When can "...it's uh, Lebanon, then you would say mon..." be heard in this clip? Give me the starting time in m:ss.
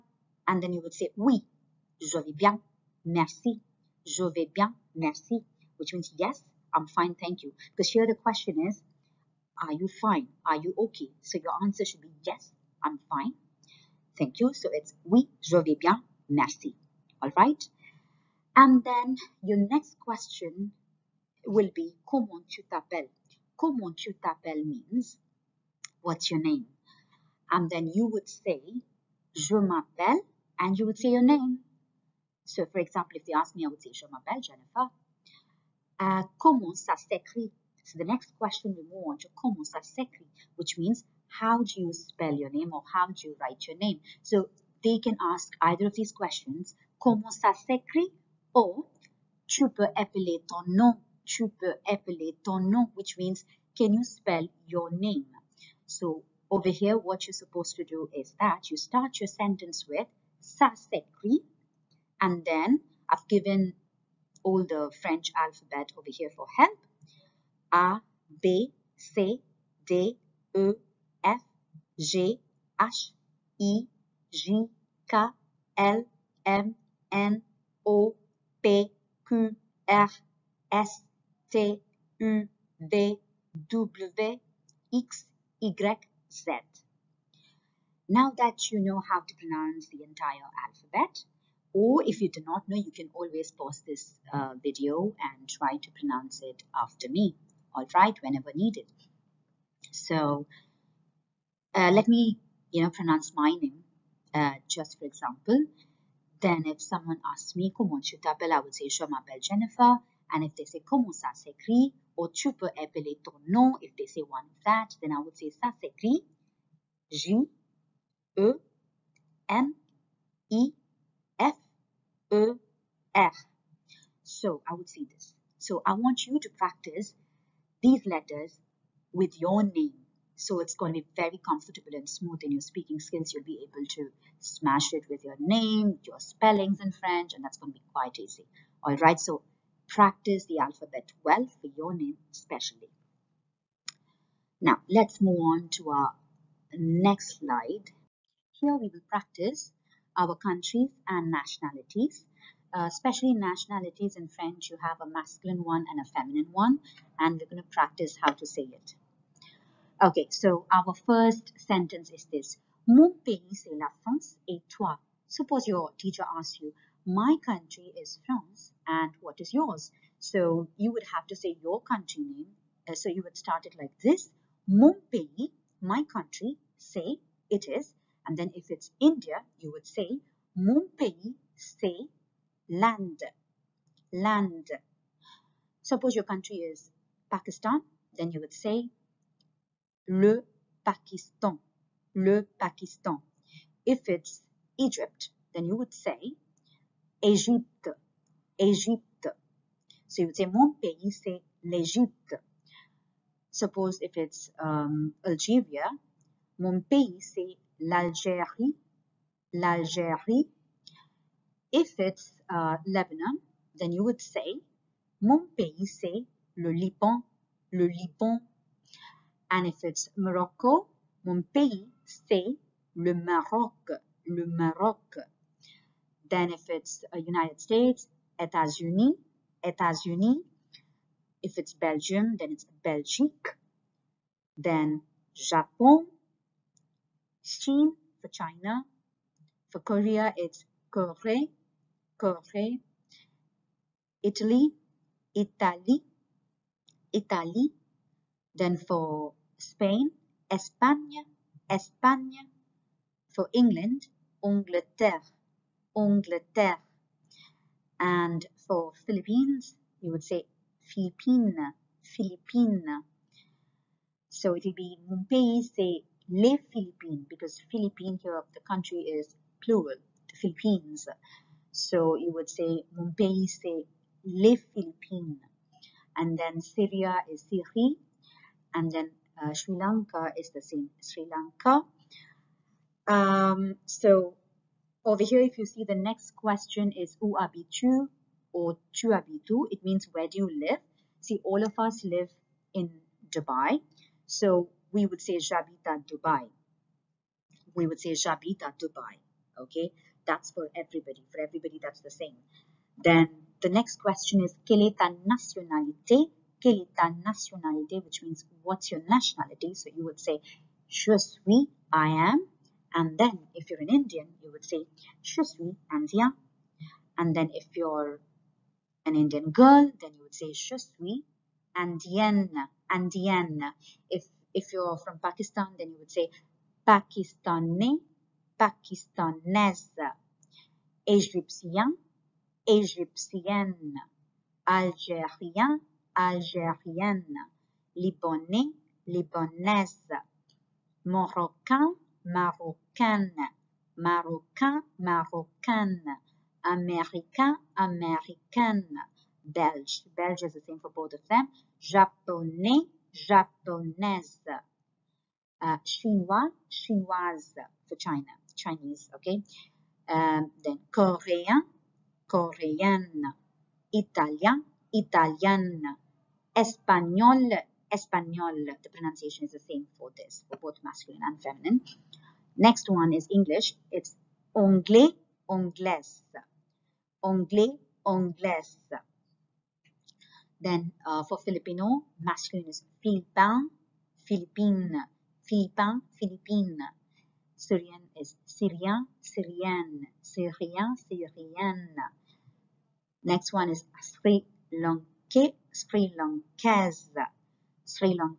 3:31.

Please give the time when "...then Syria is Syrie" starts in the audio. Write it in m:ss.
4:36.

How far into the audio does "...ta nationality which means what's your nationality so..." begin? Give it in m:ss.
5:06.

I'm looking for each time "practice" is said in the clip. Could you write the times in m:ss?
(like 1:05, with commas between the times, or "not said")
2:06, 2:19, 2:29, 2:37.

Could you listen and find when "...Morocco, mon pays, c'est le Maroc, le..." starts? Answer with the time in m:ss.
3:40.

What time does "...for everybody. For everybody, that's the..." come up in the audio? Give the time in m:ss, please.
5:00.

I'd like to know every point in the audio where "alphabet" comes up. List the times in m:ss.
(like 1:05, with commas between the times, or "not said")
1:05, 1:30, 2:20.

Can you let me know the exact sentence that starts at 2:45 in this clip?
Suppose your teacher asks you, my country is France, and what is yours?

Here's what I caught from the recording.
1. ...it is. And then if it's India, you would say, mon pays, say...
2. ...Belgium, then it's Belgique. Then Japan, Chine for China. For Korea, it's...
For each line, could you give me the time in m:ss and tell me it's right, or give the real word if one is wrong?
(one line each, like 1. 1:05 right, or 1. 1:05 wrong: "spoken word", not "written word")
1. 2:57 right
2. 3:51 right.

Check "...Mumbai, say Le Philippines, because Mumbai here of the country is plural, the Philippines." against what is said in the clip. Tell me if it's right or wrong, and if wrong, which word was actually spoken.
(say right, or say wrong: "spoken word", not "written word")
wrong: "Philippines", not "Mumbai".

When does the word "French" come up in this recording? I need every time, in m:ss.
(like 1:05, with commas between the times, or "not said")
1:05, 2:16, 2:34.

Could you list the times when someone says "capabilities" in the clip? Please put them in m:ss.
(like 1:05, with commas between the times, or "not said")
not said.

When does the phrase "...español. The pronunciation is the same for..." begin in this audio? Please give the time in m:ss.
6:07.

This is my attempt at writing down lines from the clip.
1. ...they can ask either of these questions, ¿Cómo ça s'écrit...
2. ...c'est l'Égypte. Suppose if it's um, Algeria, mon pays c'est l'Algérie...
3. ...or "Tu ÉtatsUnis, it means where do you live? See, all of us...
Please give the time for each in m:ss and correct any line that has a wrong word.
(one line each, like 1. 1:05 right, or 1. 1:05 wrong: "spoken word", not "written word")
1. 0:44 right
2. 3:21 right
3. 4:48 wrong: "Chuabitu", not "ÉtatsUnis".